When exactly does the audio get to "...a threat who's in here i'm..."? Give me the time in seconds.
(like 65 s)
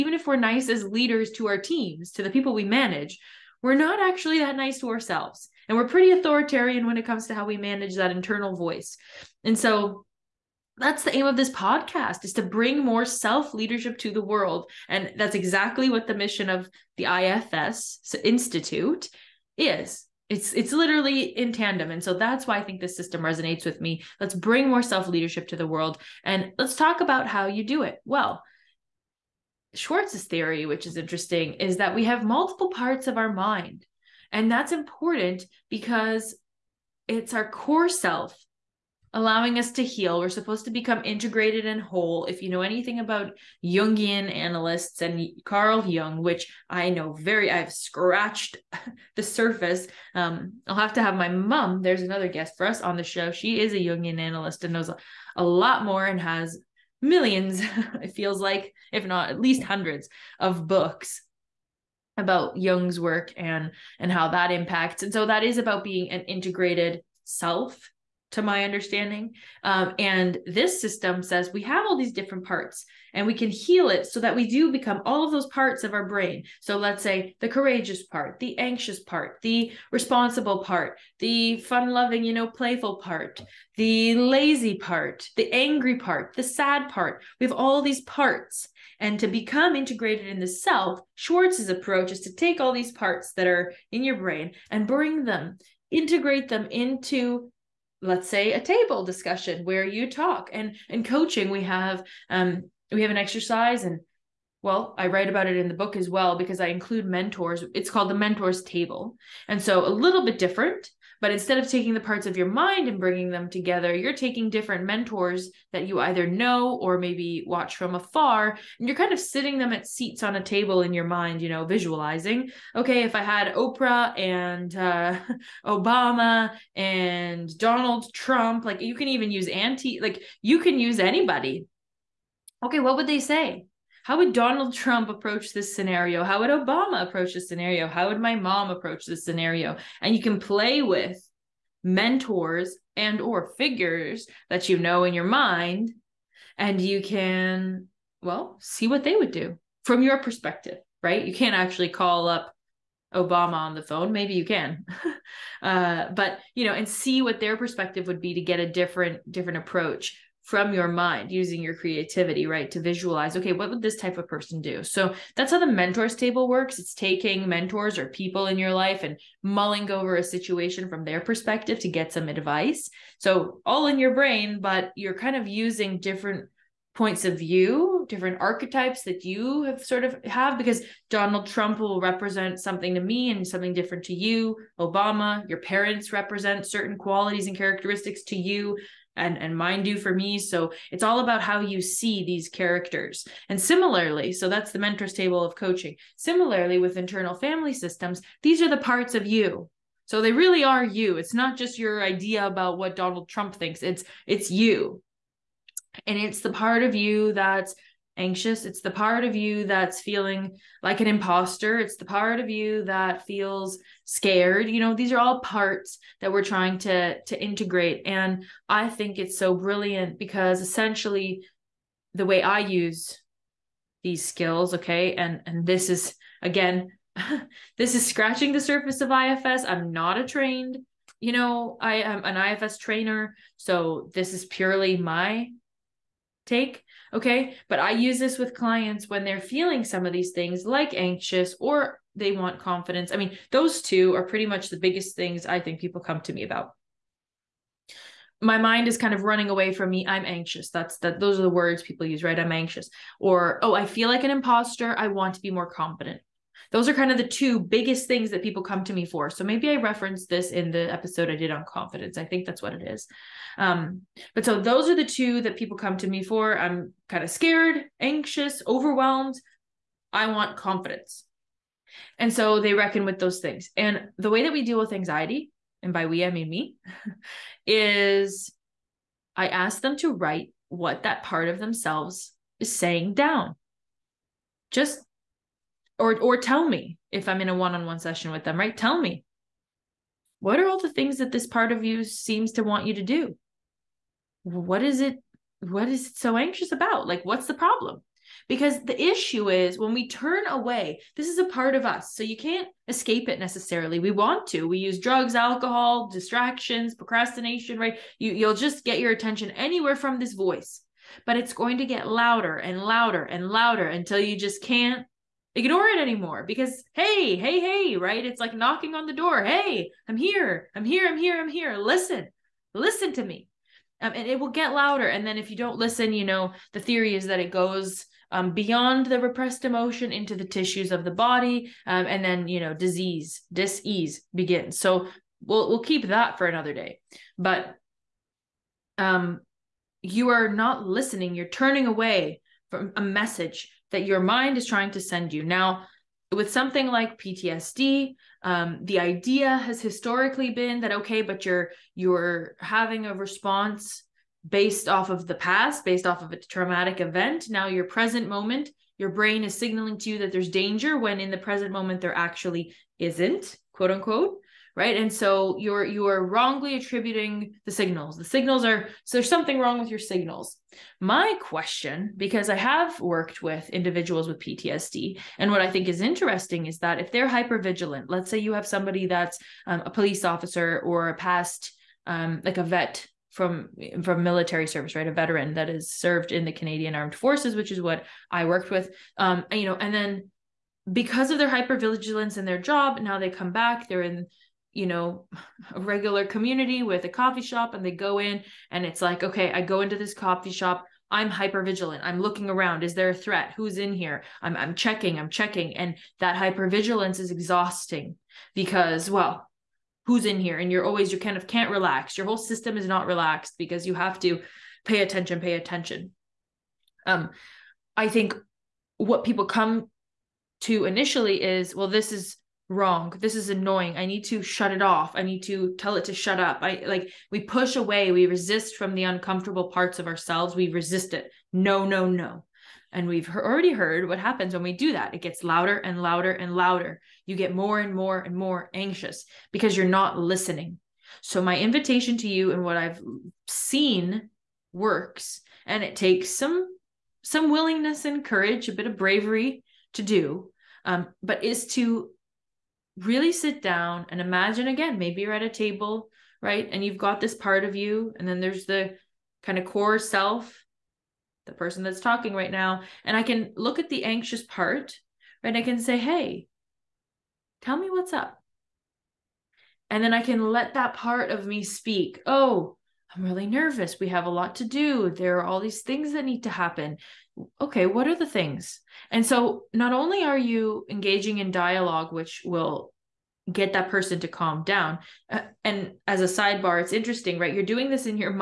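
403 s.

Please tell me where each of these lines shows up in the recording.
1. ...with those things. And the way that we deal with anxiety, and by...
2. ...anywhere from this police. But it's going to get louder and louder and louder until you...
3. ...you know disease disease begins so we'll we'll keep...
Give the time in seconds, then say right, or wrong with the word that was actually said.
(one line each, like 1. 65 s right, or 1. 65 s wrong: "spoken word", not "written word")
1. 273 s right
2. 309 s wrong: "voice", not "police"
3. 332 s right.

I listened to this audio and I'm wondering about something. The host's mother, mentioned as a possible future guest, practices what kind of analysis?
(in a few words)
Jungian analyst.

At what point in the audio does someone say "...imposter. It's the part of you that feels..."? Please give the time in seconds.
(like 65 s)
211 s.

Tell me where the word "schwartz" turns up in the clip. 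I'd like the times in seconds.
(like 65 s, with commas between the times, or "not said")
29 s, 91 s.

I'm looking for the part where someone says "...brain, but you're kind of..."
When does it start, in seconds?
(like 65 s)
174 s.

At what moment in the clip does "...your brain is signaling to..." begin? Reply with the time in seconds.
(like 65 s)
358 s.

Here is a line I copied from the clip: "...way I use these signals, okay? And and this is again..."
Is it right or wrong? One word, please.
wrong.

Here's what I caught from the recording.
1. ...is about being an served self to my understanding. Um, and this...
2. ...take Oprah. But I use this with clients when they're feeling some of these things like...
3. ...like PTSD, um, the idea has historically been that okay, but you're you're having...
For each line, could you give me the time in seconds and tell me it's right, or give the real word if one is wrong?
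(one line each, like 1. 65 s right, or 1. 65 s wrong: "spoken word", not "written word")
1. 65 s wrong: "integrated", not "served"
2. 236 s wrong: "Okay", not "Oprah"
3. 346 s right.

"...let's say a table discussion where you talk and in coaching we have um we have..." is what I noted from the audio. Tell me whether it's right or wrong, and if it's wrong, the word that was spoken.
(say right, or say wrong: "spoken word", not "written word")
right.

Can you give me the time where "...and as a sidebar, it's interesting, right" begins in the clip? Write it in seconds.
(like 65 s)
485 s.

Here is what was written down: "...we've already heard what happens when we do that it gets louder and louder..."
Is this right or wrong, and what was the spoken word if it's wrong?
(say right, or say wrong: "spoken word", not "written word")
right.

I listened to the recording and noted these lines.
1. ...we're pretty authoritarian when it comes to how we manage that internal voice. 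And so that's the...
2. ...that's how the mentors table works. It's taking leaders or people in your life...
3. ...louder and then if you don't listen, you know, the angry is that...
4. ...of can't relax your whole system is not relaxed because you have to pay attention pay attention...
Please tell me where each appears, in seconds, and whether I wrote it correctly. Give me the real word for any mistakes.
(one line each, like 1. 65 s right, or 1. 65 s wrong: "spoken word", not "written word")
1. 5 s right
2. 165 s wrong: "mentors", not "leaders"
3. 324 s wrong: "theory", not "angry"
4. 411 s right.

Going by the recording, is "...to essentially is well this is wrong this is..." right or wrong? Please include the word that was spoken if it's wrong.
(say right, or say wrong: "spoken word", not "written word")
wrong: "initially", not "essentially".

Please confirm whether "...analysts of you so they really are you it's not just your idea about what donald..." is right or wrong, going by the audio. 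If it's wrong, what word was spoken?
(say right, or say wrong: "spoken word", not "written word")
wrong: "parts", not "analysts".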